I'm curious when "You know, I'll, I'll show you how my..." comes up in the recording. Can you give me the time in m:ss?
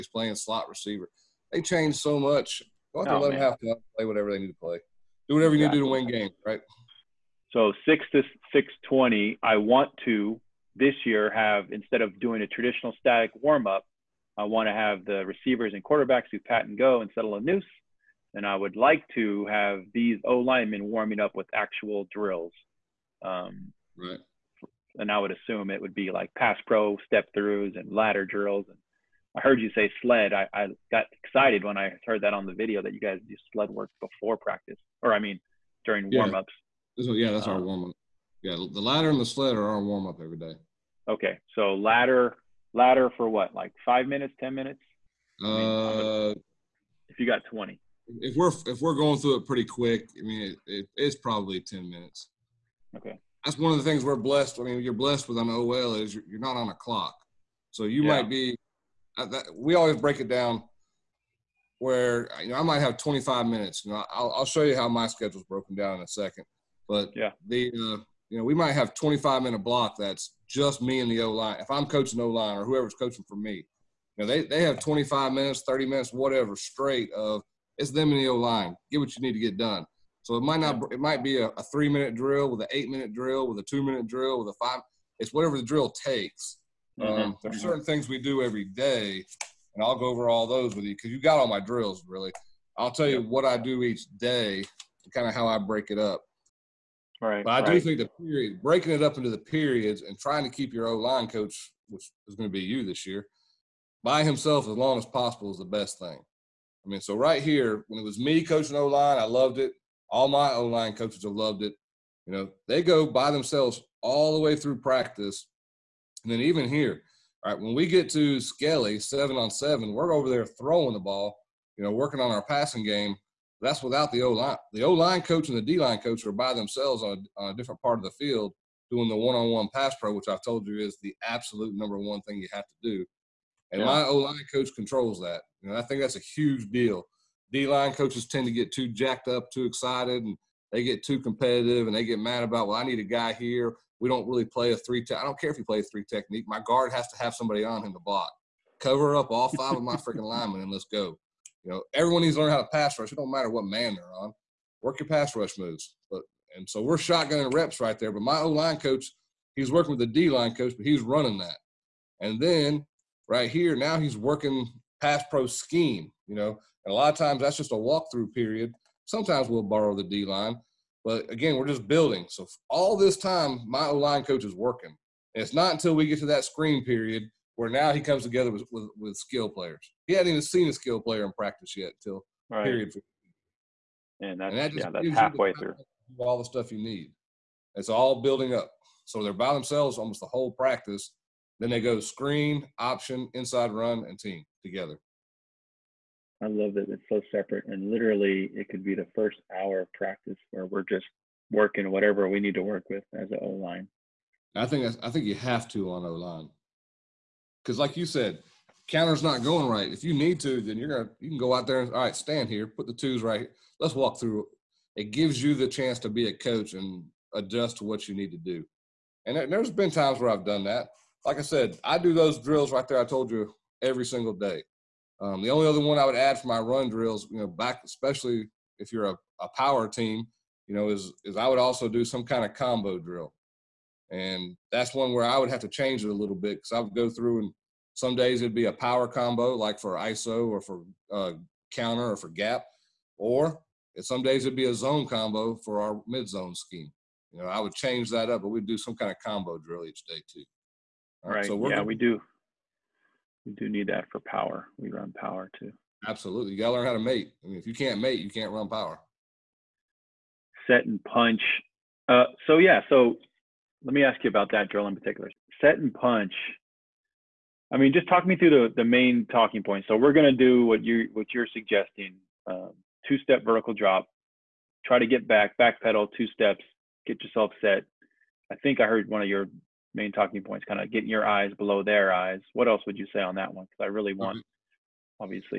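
1:03.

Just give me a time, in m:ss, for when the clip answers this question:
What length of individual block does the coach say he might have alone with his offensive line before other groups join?
1:08.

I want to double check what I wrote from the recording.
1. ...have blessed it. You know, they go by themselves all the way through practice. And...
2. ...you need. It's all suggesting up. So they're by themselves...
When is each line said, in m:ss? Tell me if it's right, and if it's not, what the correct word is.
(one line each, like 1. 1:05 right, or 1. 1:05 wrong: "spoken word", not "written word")
1. 1:51 wrong: "loved", not "blessed"
2. 3:06 wrong: "building", not "suggesting".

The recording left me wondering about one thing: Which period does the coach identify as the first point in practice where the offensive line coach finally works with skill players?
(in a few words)
screen period.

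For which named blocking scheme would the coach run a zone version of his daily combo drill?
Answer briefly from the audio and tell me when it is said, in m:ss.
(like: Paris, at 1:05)
mid zone, at 4:06.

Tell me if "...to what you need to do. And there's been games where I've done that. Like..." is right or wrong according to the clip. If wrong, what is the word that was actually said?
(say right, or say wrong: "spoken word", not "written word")
wrong: "times", not "games".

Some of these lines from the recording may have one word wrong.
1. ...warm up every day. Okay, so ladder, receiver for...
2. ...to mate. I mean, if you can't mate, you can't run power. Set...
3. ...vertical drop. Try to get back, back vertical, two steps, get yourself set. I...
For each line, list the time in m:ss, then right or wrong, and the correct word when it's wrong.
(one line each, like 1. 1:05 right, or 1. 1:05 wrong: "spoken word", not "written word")
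1. 0:39 wrong: "ladder", not "receiver"
2. 4:16 right
3. 4:33 wrong: "pedal", not "vertical".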